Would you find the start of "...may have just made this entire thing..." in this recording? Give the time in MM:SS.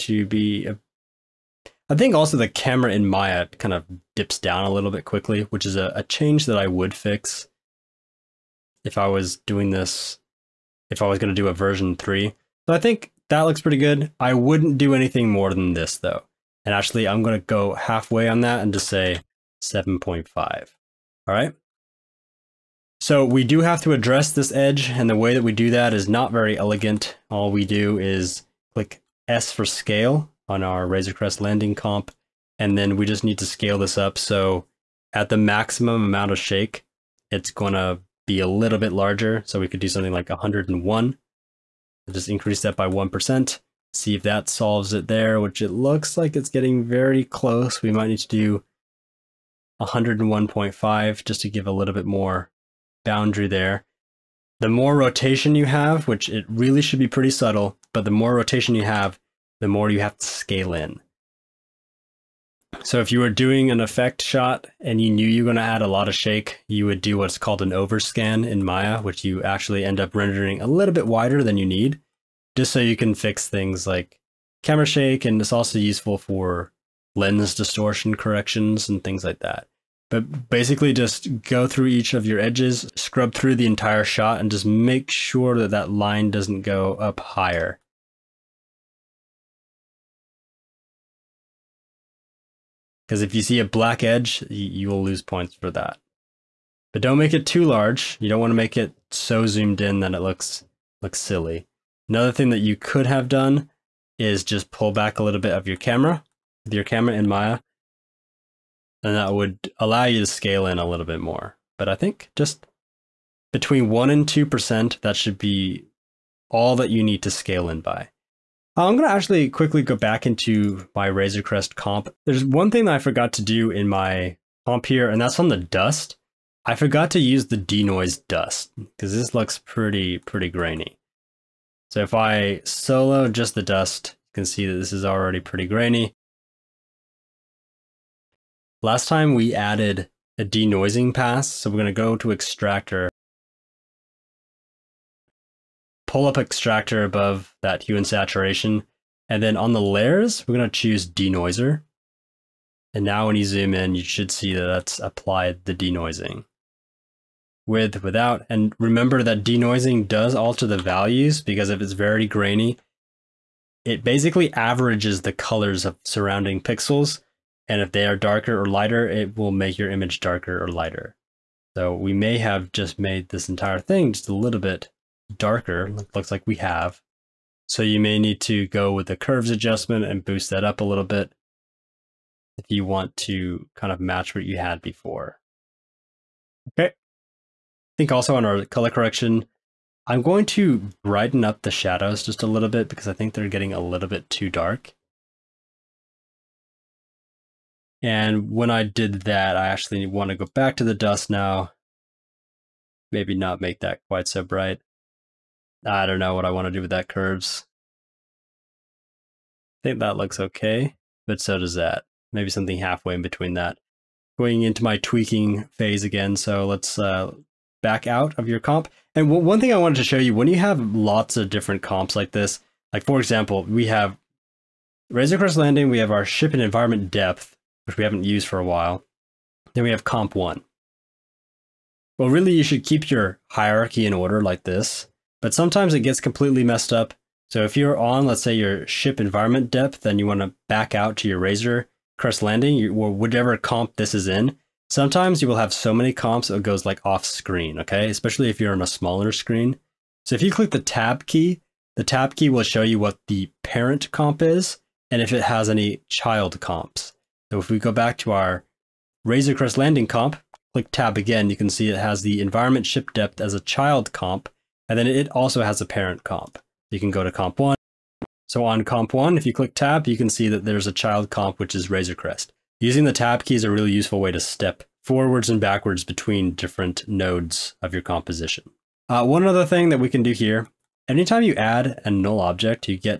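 02:52.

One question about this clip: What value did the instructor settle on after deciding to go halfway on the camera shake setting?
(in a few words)
7.5.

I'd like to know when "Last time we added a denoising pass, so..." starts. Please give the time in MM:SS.
02:18.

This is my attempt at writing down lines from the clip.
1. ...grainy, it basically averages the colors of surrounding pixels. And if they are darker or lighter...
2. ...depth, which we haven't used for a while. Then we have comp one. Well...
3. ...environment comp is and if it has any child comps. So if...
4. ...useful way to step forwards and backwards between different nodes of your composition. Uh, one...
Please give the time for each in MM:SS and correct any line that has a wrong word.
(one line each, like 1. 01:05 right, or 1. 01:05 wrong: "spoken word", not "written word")
1. 02:42 right
2. 03:47 right
3. 04:13 wrong: "parent", not "environment"
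4. 04:33 right.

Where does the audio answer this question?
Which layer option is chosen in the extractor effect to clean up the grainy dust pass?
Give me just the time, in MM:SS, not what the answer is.
02:31.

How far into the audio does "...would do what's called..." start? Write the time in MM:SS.
01:06.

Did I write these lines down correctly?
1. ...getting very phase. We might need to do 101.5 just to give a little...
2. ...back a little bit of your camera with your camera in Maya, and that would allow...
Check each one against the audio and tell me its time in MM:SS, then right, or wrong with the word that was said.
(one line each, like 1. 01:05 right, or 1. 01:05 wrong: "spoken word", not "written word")
1. 00:46 wrong: "close", not "phase"
2. 01:44 right.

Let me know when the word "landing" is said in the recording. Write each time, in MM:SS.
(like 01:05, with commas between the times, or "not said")
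00:31, 03:45, 04:02, 04:19.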